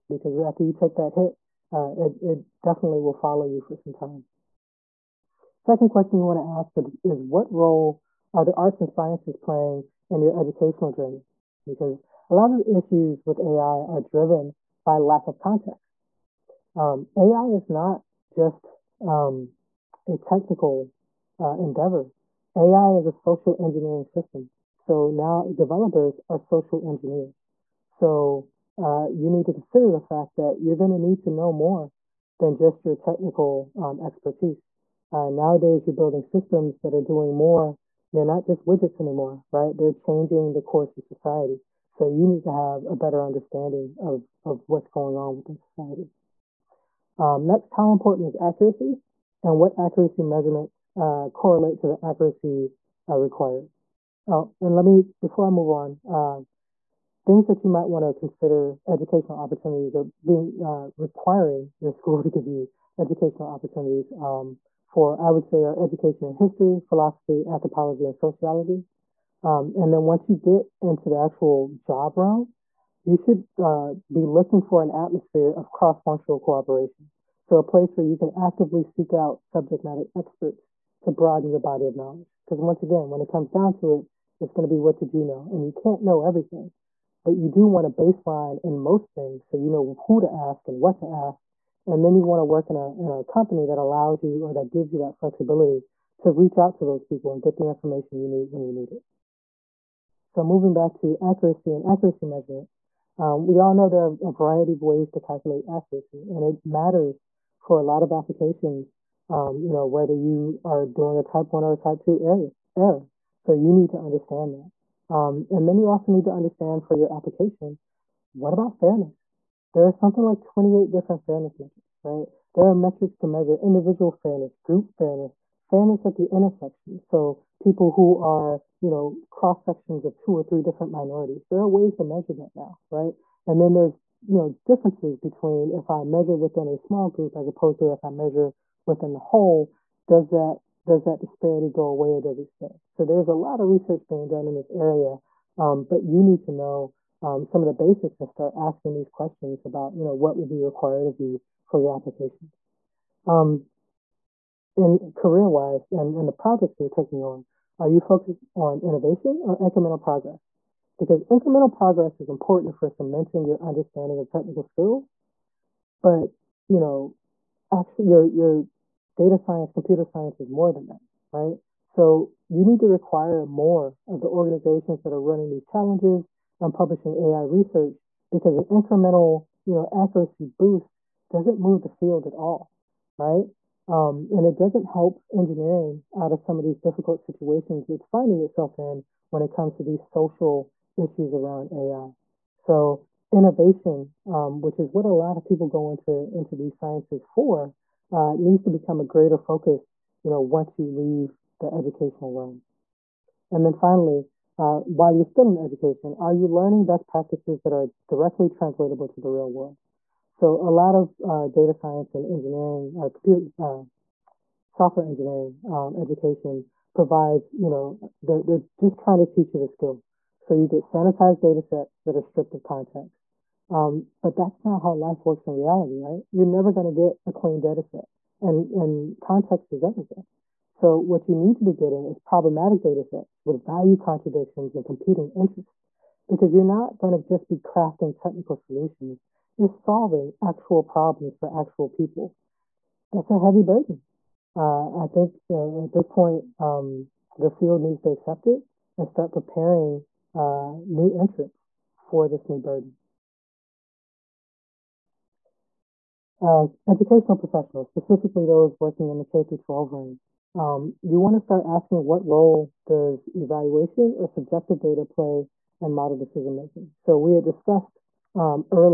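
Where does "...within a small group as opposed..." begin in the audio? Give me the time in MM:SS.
02:16.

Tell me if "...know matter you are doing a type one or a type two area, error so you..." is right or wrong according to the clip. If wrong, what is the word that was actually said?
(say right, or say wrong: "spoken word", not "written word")
wrong: "whether", not "matter".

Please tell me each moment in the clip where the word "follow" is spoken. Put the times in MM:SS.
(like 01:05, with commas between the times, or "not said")
00:03.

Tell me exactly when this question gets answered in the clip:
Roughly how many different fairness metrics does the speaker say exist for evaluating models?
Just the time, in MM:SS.
02:00.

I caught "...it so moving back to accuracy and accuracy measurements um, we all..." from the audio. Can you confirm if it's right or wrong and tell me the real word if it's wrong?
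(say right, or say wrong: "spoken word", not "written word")
right.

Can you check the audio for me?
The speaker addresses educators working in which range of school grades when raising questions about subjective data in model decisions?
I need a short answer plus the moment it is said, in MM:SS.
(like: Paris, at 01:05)
K through 12, at 04:19.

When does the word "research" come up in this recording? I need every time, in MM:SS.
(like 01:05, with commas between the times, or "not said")
02:23, 02:57.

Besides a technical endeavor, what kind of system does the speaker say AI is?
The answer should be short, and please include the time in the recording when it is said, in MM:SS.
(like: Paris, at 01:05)
Social engineering system, at 00:23.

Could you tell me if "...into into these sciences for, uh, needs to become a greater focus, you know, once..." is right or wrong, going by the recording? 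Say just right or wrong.
right.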